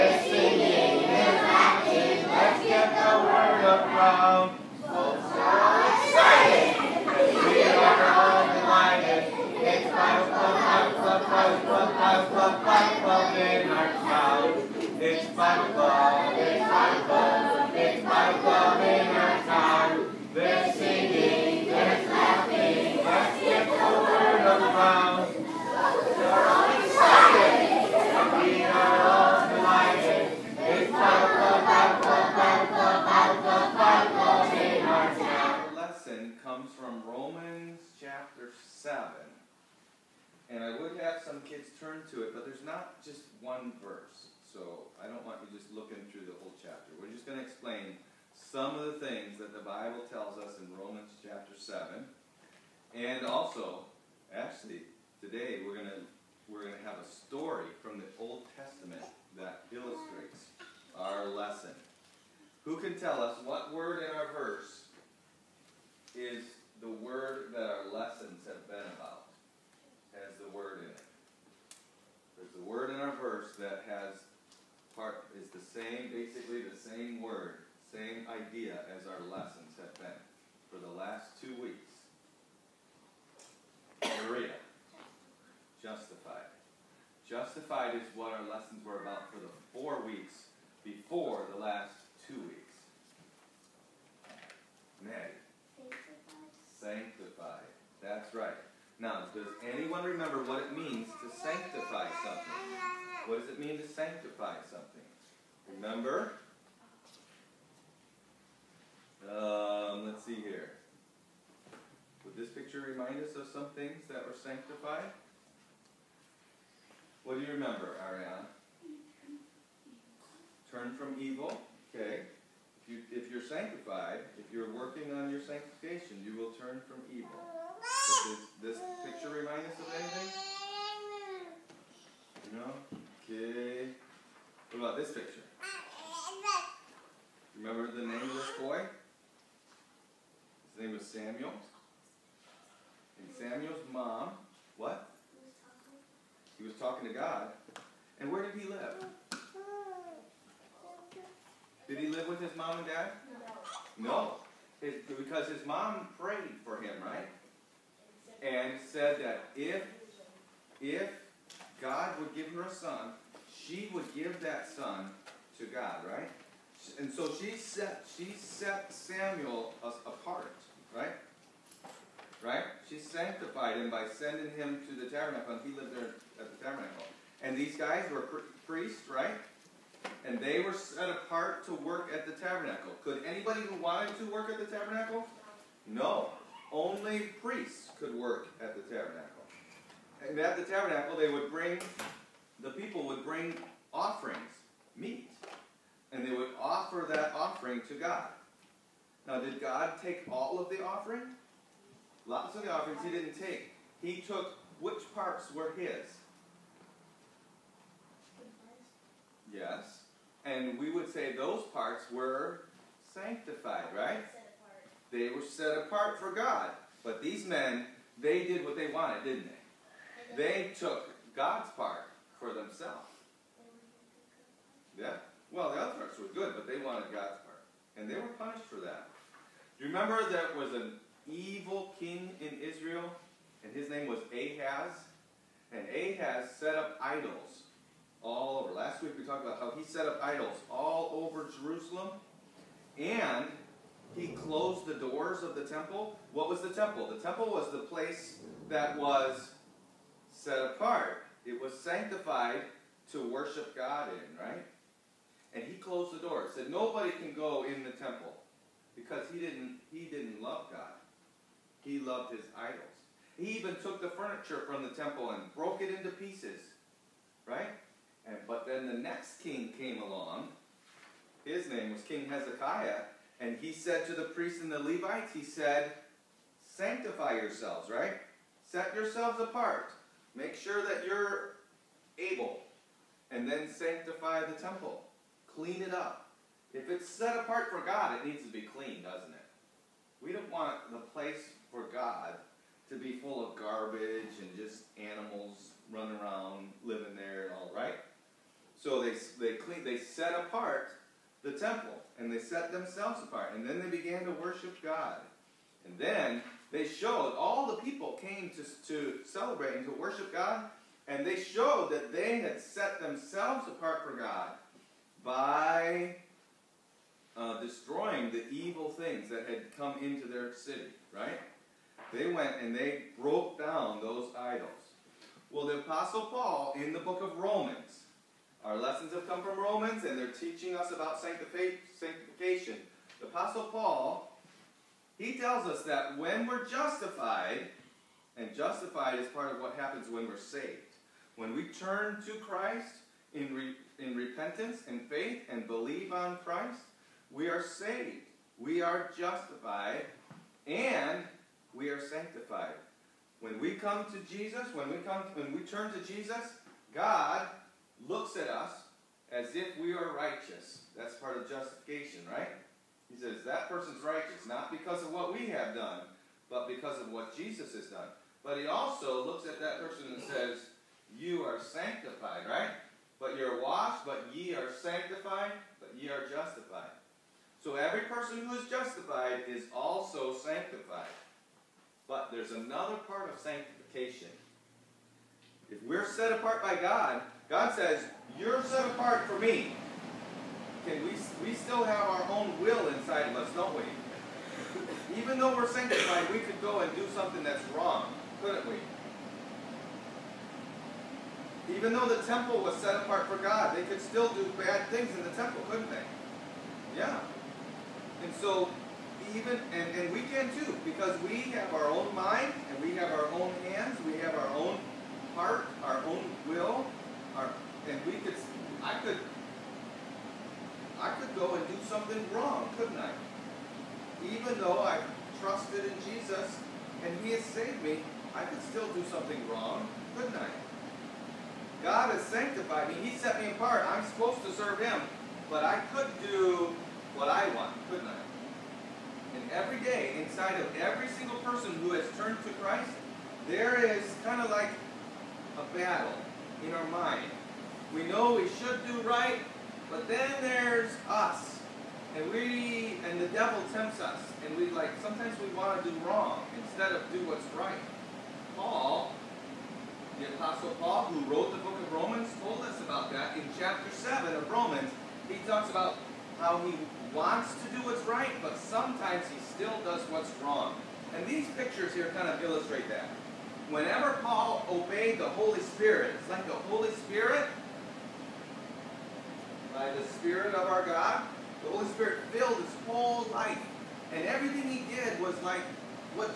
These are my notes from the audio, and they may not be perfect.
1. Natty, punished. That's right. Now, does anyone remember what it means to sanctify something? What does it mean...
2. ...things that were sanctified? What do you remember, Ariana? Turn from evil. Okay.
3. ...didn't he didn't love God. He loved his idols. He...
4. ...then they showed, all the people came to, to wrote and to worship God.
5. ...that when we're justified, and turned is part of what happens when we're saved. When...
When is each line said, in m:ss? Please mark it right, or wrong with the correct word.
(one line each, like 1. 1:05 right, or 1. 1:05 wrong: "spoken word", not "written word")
1. 1:35 wrong: "sanctified", not "punished"
2. 1:53 right
3. 4:19 right
4. 5:05 wrong: "celebrate", not "wrote"
5. 5:35 wrong: "justified", not "turned".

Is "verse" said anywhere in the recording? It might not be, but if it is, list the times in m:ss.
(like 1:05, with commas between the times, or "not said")
0:43, 1:04, 1:13.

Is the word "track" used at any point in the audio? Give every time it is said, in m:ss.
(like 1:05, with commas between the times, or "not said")
not said.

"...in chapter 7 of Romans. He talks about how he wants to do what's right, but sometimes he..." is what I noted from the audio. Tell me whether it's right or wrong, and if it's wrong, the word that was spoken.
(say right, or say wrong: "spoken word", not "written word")
right.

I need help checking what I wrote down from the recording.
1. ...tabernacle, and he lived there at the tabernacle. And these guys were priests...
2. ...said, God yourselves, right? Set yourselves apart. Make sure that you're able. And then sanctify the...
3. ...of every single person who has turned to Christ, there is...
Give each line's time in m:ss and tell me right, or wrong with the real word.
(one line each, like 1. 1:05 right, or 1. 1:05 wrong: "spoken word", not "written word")
1. 2:55 right
2. 4:35 wrong: "Sanctify", not "God"
3. 7:20 right.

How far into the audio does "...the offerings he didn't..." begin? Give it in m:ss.
3:22.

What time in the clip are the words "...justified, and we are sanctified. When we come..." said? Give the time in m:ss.
5:49.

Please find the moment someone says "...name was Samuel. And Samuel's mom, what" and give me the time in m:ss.
2:20.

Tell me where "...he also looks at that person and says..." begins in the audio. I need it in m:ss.
6:08.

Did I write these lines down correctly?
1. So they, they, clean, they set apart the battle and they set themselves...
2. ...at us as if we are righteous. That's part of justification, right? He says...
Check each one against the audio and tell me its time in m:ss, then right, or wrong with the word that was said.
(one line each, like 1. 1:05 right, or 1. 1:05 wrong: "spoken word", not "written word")
1. 4:58 wrong: "temple", not "battle"
2. 5:58 right.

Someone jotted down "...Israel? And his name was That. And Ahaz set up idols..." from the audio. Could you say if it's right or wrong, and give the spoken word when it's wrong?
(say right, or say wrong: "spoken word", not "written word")
wrong: "Ahaz", not "That".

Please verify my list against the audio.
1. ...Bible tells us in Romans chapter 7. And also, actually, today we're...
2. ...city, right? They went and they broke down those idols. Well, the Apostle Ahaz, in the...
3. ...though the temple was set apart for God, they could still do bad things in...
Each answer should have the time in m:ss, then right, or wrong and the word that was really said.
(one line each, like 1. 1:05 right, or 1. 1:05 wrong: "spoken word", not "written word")
1. 0:49 right
2. 5:20 wrong: "Paul", not "Ahaz"
3. 6:41 right.